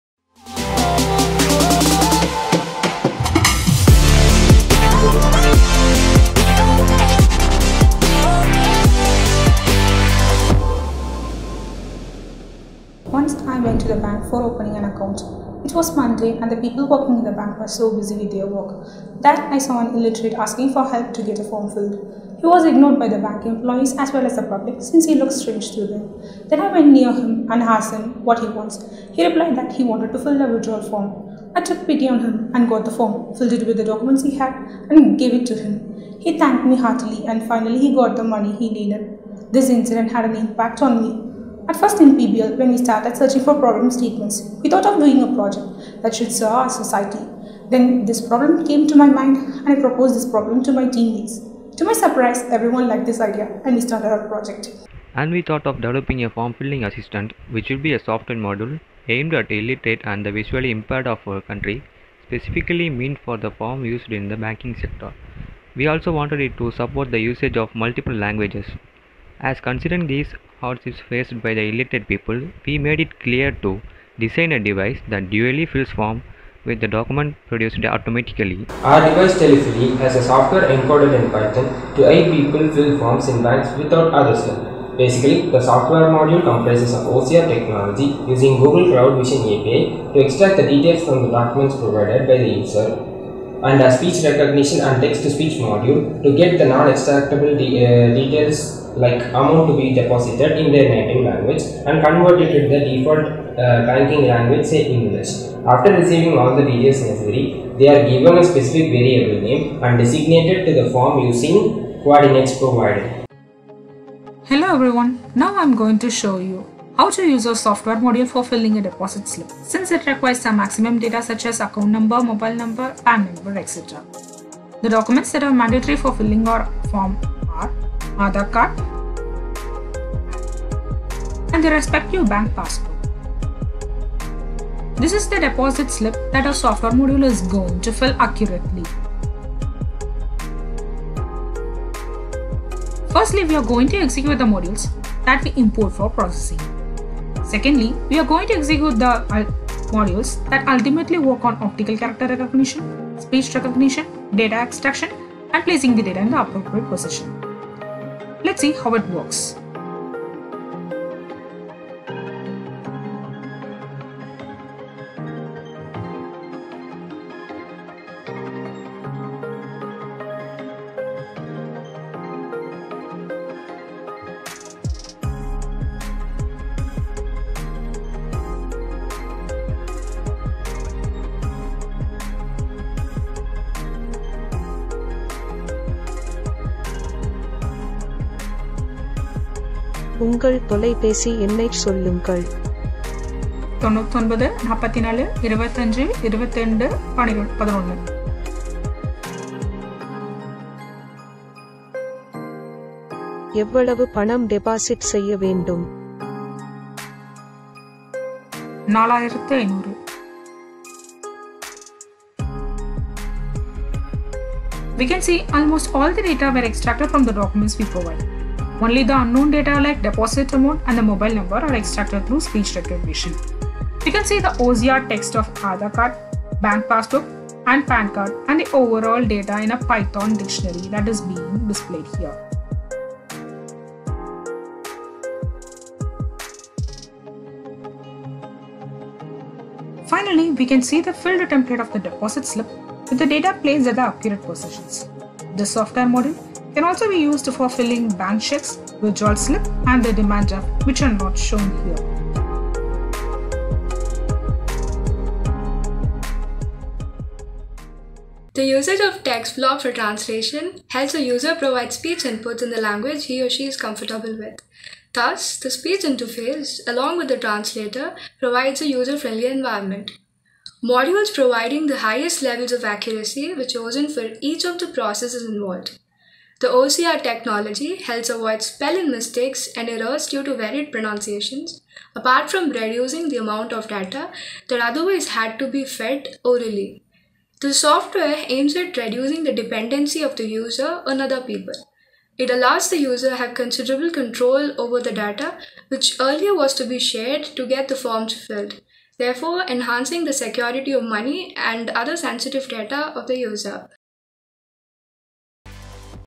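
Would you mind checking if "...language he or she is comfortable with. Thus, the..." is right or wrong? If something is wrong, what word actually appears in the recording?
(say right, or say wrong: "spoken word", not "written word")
right.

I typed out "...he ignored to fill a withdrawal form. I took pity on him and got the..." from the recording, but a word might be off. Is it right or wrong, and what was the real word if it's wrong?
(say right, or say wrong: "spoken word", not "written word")
wrong: "wanted", not "ignored".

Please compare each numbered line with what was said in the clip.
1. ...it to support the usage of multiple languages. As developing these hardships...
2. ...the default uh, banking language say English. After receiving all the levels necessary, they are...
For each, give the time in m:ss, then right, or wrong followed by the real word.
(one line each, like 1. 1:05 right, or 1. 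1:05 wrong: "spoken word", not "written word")
1. 1:06 wrong: "considering", not "developing"
2. 1:42 wrong: "details", not "levels".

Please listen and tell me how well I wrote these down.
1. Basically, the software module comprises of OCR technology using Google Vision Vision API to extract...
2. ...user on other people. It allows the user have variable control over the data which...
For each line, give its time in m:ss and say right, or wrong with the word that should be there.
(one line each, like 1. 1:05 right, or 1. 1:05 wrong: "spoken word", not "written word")
1. 1:24 wrong: "Cloud", not "Vision"
2. 4:50 wrong: "considerable", not "variable".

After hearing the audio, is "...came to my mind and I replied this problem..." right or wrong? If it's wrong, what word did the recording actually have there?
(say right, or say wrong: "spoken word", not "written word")
wrong: "proposed", not "replied".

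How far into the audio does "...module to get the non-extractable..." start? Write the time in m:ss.
1:35.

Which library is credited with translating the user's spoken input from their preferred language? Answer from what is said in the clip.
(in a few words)
TextBlob.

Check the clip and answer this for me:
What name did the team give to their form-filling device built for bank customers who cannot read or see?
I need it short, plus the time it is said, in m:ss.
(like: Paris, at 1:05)
TELLY-FILLY, at 1:19.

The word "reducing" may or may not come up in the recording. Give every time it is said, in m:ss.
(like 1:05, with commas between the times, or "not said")
4:42, 4:48.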